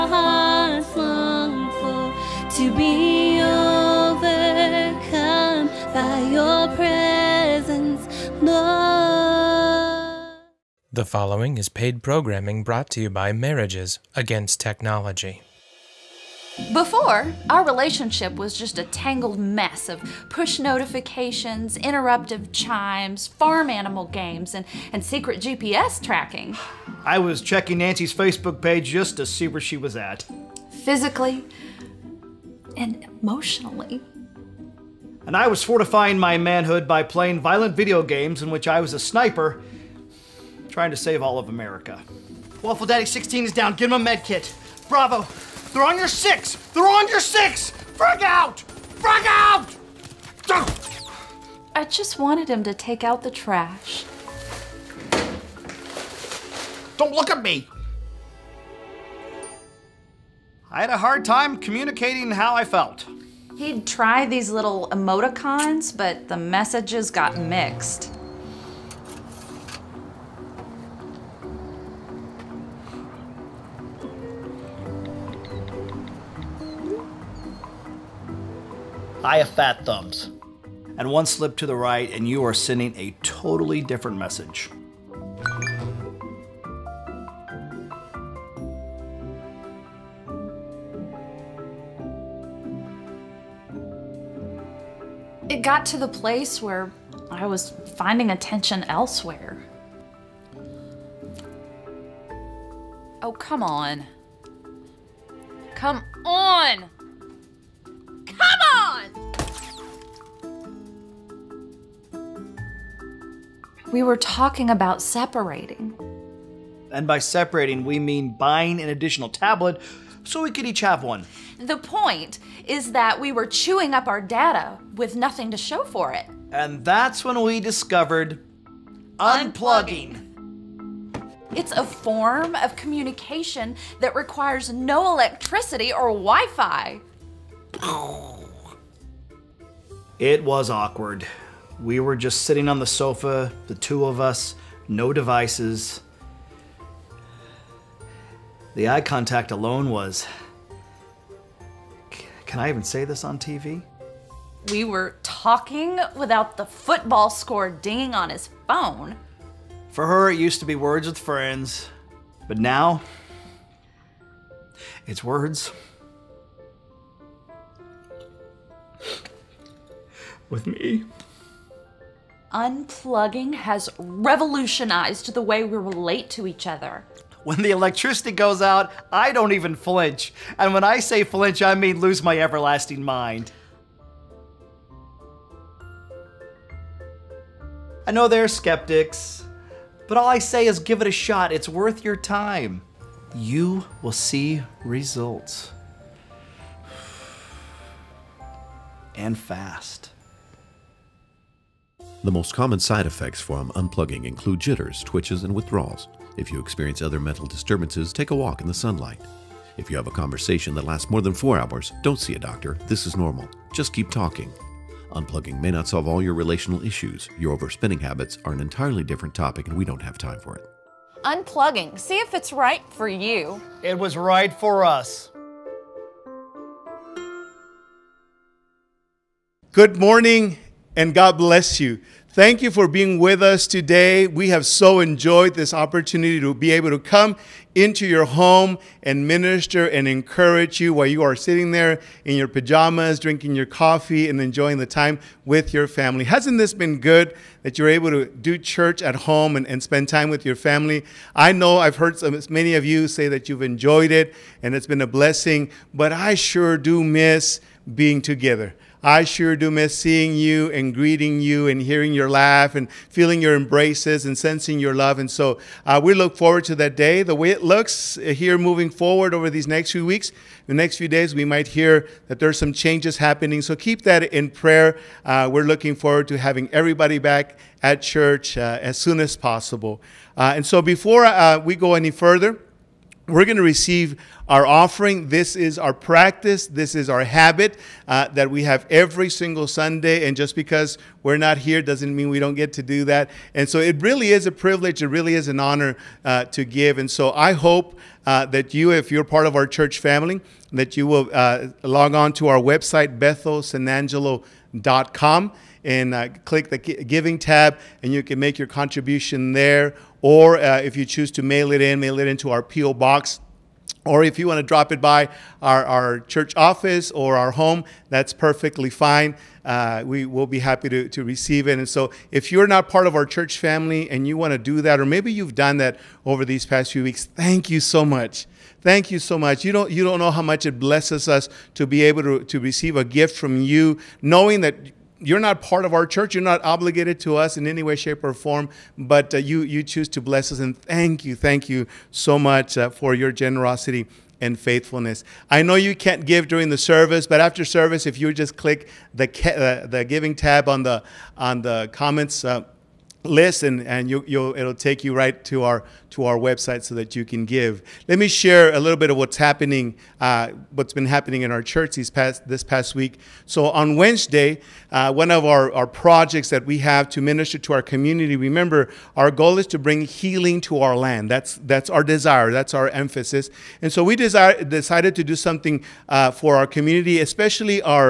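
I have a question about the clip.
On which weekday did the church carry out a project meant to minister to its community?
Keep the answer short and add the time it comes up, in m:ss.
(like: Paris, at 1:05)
Wednesday, at 6:03.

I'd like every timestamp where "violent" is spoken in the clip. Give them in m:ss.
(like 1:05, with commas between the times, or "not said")
0:37.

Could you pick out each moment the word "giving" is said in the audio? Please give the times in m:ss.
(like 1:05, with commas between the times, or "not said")
5:06, 5:50.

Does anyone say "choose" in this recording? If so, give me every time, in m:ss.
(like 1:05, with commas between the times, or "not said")
5:11, 5:39.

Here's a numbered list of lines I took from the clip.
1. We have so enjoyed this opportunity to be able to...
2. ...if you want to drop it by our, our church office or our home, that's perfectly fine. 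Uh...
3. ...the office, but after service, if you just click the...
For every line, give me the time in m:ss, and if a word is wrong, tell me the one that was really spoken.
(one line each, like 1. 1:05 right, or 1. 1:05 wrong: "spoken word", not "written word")
1. 3:54 right
2. 5:14 right
3. 5:46 wrong: "service", not "office".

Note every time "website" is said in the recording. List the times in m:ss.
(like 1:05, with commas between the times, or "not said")
5:02, 5:56.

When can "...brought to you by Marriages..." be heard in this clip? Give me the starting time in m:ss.
0:12.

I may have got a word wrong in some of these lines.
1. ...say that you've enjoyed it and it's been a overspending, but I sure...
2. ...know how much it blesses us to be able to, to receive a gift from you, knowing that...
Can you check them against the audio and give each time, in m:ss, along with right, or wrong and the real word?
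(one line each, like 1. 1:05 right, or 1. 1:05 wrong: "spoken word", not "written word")
1. 4:13 wrong: "blessing", not "overspending"
2. 5:30 right.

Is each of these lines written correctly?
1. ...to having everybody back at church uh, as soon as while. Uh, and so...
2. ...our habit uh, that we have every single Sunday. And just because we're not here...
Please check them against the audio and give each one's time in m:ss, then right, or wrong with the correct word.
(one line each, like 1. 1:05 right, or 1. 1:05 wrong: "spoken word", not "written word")
1. 4:36 wrong: "possible", not "while"
2. 4:47 right.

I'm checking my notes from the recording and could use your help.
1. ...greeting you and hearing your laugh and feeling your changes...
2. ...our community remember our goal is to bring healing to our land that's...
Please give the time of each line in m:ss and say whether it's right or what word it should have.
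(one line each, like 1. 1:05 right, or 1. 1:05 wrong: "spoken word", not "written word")
1. 4:20 wrong: "embraces", not "changes"
2. 6:07 right.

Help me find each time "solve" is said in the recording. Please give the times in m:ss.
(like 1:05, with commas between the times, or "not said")
3:35.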